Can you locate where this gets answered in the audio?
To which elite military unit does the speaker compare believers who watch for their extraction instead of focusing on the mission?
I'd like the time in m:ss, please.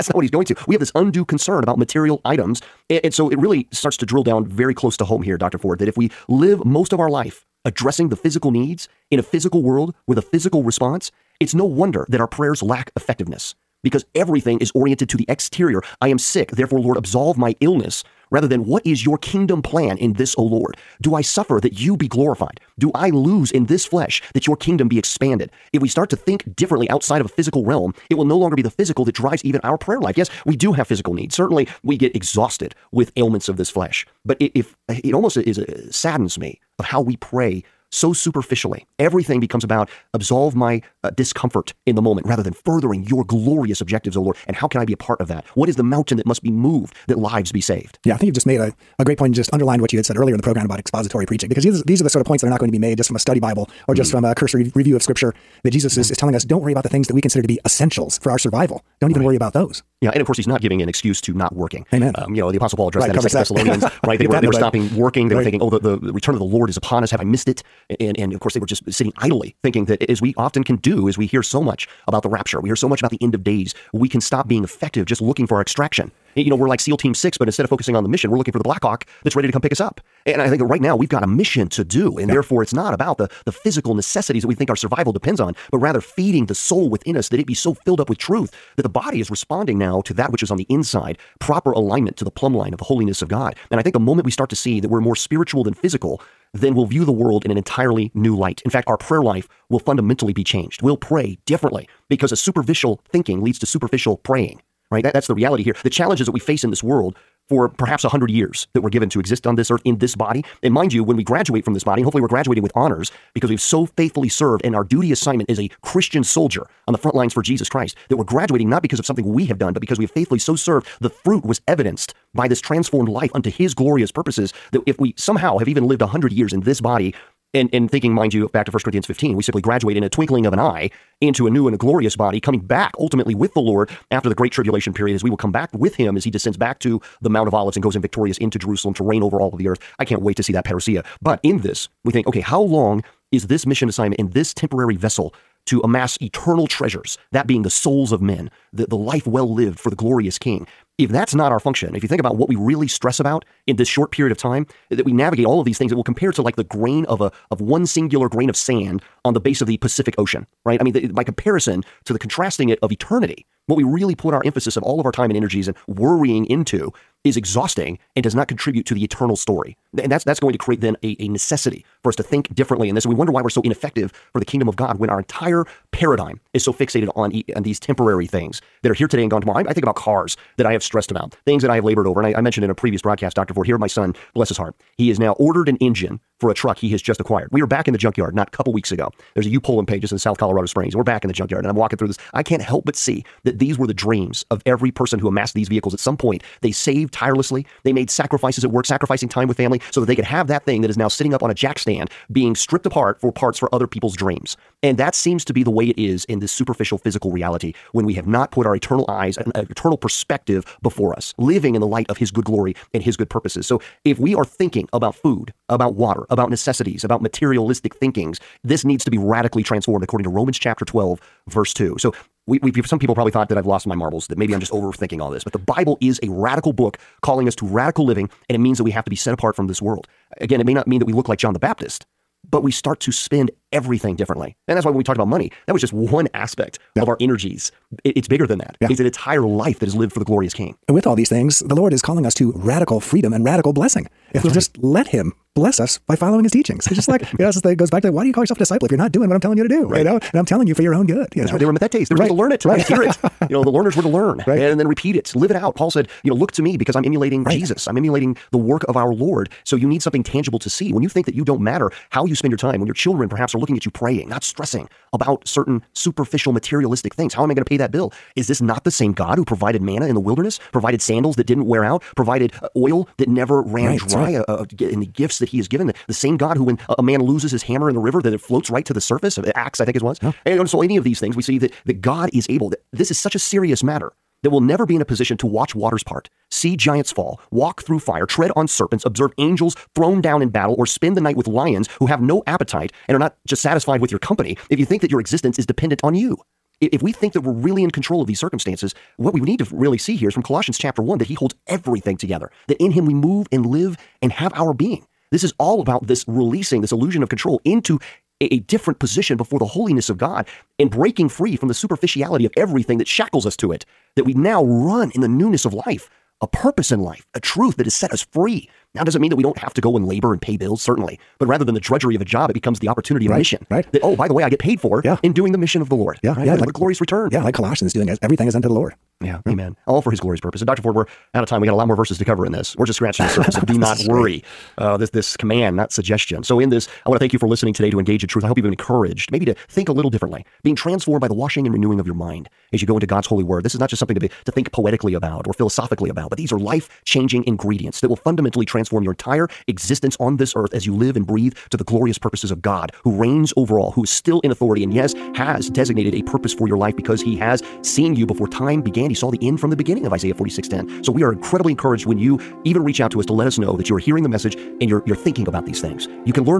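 1:16.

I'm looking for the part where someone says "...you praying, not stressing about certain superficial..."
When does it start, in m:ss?
4:23.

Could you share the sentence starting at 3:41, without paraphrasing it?
So we, we some people probably thought that I've lost my marbles, that maybe I'm just overthinking all this.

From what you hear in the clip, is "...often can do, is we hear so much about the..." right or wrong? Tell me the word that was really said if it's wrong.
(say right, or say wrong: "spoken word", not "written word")
right.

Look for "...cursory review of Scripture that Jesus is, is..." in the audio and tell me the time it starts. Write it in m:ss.
0:54.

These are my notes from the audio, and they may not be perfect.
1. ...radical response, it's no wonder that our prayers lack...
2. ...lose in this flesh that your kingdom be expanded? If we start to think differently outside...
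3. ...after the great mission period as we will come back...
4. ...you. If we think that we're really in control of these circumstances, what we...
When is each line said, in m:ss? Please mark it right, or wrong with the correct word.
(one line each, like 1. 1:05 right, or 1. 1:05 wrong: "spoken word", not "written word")
1. 0:10 wrong: "physical", not "radical"
2. 0:23 right
3. 2:14 wrong: "tribulation", not "mission"
4. 4:56 right.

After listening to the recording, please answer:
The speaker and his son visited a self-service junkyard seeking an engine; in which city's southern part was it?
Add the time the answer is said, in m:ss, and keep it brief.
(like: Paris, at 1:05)
Colorado Springs, at 3:10.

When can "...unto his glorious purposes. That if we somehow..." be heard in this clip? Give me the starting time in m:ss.
2:03.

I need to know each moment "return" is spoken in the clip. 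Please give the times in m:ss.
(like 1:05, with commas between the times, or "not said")
1:06, 5:26.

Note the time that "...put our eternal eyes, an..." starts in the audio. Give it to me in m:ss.
3:28.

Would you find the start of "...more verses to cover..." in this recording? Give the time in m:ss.
5:31.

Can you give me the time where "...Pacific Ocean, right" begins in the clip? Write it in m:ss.
2:39.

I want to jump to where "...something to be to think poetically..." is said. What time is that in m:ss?
5:43.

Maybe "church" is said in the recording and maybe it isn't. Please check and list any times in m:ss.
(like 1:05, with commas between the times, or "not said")
not said.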